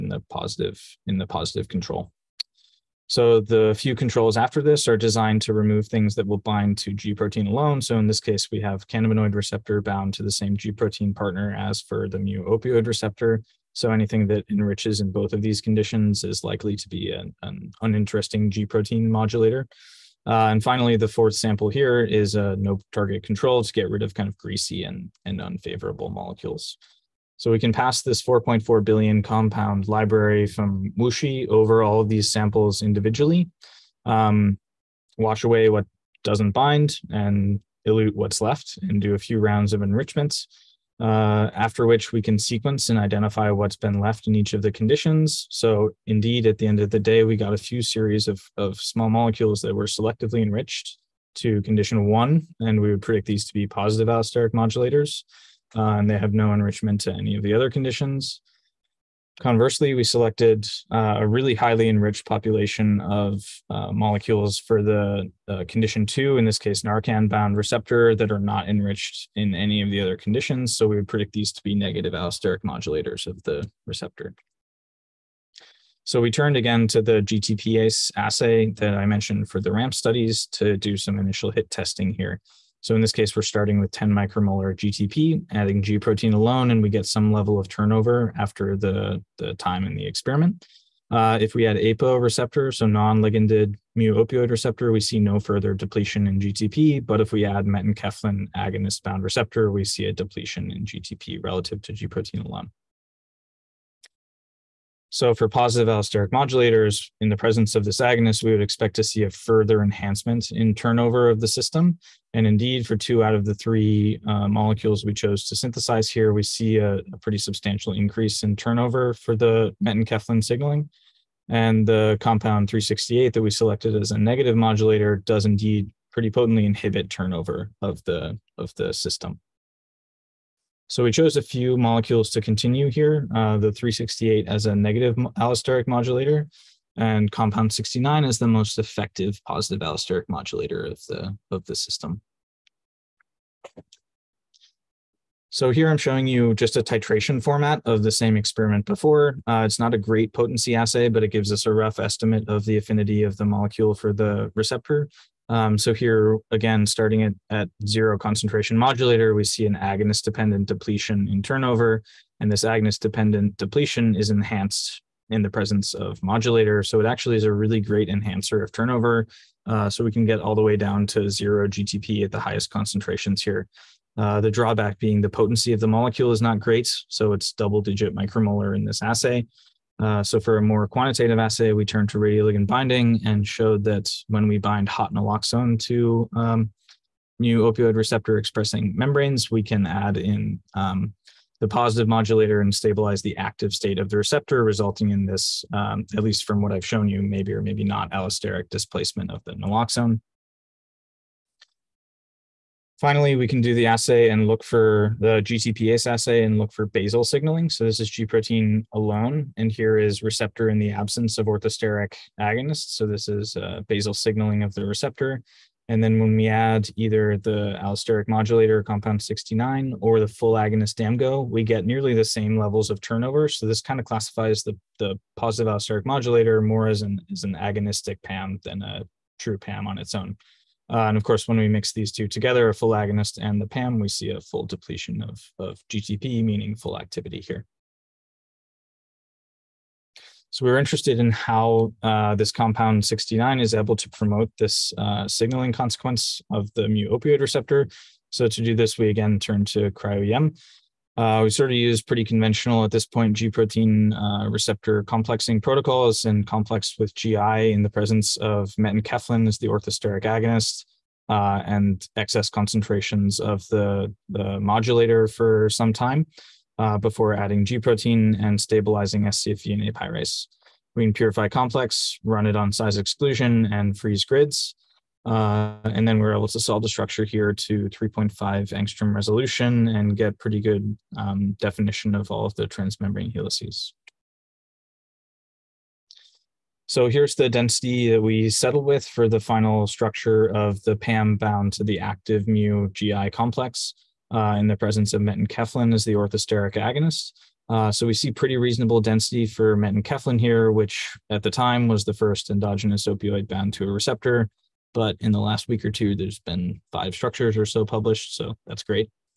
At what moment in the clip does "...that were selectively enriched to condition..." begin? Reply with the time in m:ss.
0:49.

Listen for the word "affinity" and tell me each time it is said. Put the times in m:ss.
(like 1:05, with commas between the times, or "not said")
2:32.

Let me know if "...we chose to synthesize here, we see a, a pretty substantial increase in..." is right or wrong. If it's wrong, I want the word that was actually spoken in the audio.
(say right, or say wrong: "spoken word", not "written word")
right.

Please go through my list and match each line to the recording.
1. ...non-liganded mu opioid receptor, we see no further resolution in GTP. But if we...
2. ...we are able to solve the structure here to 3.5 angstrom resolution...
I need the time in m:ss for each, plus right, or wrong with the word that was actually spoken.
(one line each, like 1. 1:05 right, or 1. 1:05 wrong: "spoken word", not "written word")
1. 1:32 wrong: "depletion", not "resolution"
2. 4:36 right.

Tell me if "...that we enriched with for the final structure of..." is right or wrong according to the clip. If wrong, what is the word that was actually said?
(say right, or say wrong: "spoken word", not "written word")
wrong: "settled", not "enriched".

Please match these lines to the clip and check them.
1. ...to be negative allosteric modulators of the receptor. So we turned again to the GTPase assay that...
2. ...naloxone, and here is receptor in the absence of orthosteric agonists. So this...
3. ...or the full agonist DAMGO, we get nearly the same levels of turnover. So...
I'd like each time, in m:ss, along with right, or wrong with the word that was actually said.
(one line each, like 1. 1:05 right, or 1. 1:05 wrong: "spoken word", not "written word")
1. 1:11 right
2. 3:28 wrong: "alone", not "naloxone"
3. 3:40 right.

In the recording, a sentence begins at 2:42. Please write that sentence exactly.
And this agonist dependent depletion is enhanced in the presence of modulator.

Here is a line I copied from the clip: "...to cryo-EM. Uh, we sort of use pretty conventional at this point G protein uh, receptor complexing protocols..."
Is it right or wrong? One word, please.
right.